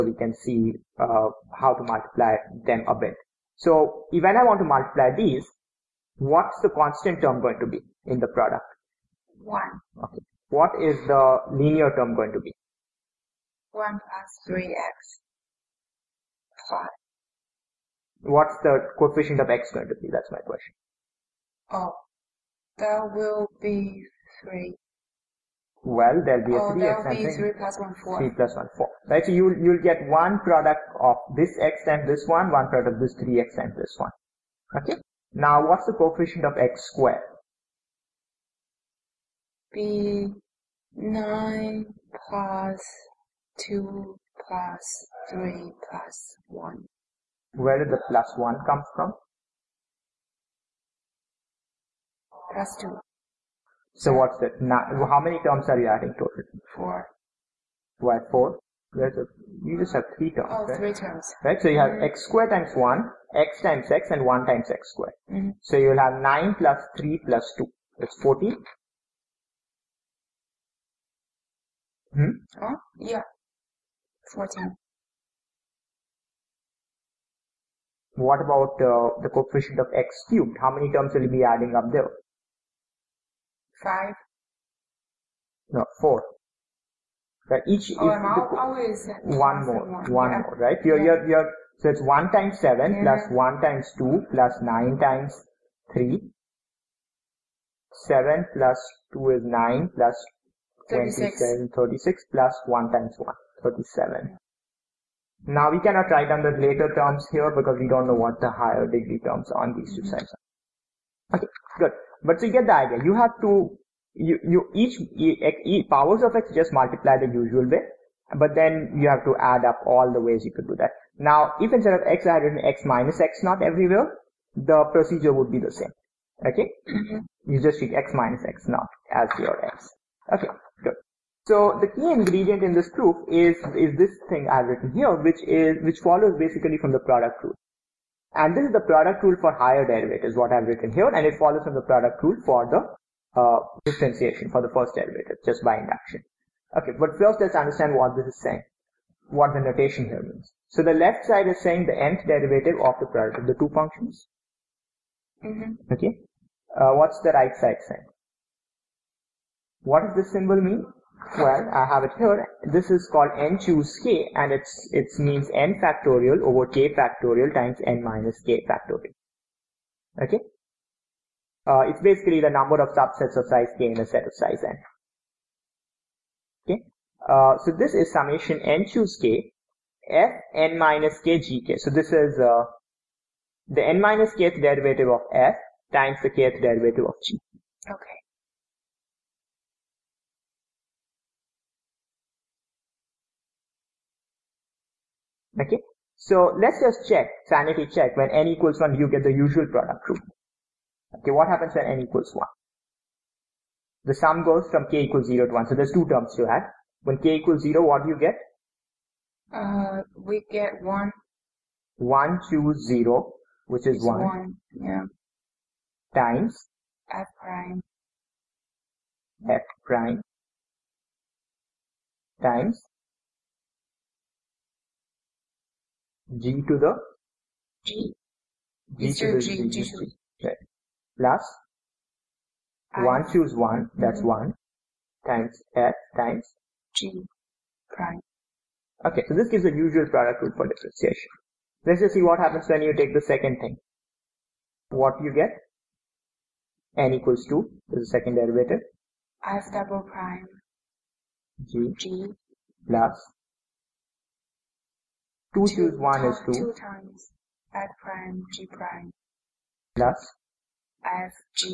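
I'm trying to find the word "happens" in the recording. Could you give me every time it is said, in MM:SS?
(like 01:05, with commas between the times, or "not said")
03:21, 04:02.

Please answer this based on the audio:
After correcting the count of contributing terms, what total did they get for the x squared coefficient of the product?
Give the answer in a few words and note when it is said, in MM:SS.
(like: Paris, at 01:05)
14, at 01:07.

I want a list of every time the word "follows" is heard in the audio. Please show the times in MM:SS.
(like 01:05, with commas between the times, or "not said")
02:16, 02:21.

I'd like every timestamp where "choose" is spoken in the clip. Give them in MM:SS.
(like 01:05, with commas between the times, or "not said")
02:43, 02:58, 03:53, 04:15.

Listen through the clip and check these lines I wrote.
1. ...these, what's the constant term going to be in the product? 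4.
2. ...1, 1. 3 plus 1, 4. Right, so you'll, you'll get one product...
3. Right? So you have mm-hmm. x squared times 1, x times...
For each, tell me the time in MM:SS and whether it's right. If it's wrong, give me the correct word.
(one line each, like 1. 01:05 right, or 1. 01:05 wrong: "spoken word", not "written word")
1. 00:05 wrong: "1", not "4"
2. 00:27 wrong: "4", not "1"
3. 01:01 right.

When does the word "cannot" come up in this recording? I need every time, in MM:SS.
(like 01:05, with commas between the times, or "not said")
01:45.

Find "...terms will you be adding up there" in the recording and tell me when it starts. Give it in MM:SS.
01:20.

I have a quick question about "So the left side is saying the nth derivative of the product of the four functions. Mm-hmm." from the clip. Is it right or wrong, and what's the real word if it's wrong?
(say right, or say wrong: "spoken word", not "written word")
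wrong: "two", not "four".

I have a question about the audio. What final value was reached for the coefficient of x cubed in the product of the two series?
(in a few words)
37.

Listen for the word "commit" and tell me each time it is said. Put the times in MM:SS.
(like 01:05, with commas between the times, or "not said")
not said.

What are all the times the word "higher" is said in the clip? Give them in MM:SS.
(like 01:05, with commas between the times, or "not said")
01:48, 02:19.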